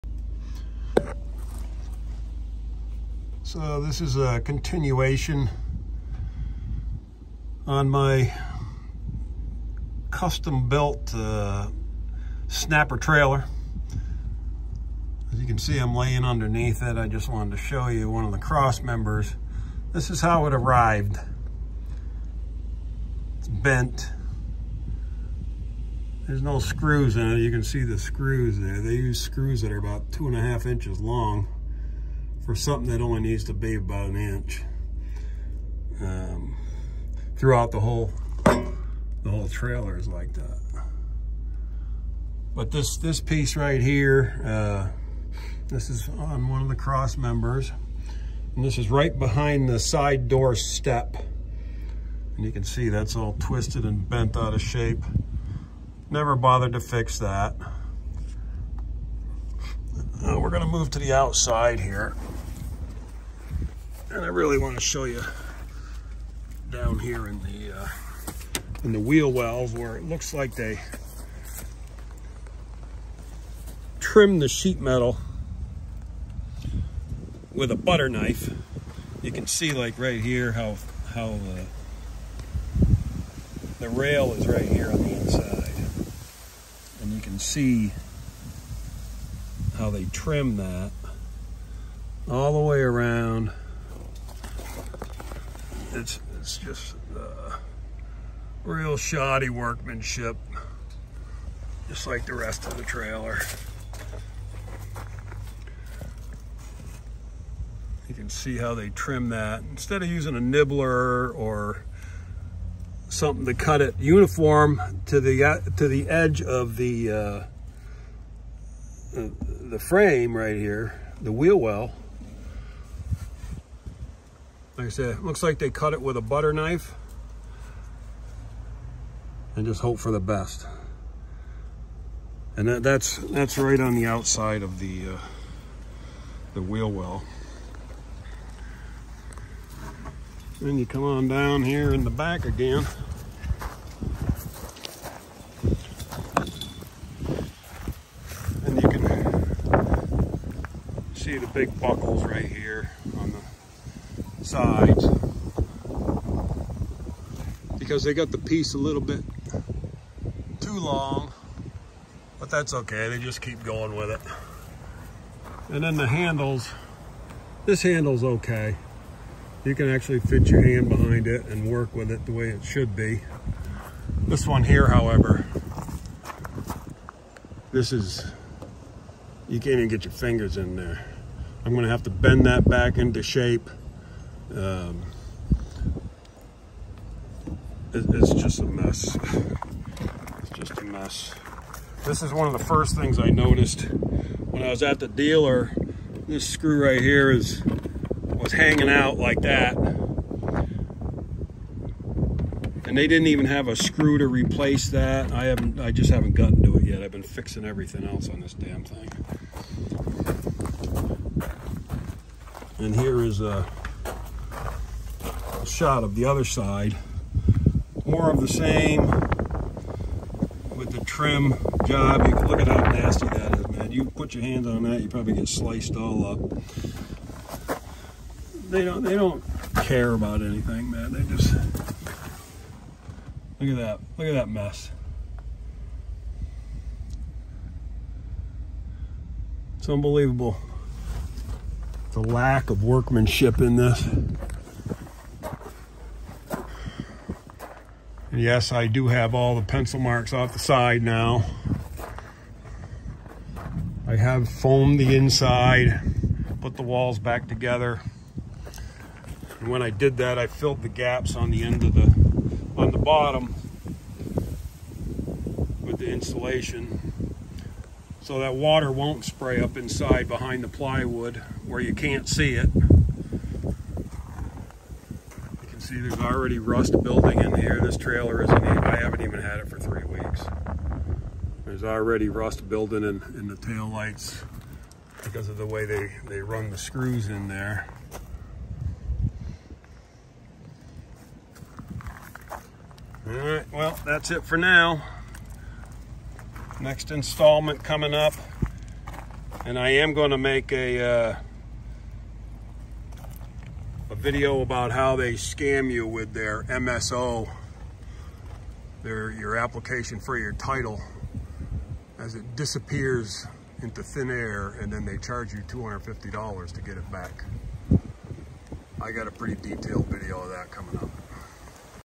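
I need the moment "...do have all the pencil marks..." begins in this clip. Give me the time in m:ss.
4:08.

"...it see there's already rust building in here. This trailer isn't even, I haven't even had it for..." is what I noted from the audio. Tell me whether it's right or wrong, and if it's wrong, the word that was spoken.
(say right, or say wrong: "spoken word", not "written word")
right.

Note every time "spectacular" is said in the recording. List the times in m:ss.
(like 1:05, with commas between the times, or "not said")
not said.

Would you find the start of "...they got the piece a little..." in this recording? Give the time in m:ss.
2:38.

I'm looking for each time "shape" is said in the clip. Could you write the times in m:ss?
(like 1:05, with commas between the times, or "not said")
0:54, 3:03.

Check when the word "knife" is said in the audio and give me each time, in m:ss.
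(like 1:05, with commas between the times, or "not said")
1:18, 2:06.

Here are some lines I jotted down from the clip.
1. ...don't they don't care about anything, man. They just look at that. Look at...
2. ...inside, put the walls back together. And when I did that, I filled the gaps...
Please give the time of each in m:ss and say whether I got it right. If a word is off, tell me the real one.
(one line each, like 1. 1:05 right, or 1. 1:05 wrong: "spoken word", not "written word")
1. 3:48 right
2. 4:15 right.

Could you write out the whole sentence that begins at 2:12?
And that, that's that's right on the outside of the uh, the wheel well.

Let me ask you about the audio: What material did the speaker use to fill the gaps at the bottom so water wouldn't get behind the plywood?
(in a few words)
Insulation.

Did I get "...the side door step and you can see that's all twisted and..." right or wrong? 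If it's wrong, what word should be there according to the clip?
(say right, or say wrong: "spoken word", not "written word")
right.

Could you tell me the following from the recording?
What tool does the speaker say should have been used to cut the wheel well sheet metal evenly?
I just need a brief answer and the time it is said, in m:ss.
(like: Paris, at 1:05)
A nibbler, at 1:50.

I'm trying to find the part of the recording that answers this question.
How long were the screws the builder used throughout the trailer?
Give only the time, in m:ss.
0:30.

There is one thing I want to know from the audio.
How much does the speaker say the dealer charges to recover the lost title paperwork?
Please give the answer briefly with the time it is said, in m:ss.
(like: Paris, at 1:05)
$250, at 5:15.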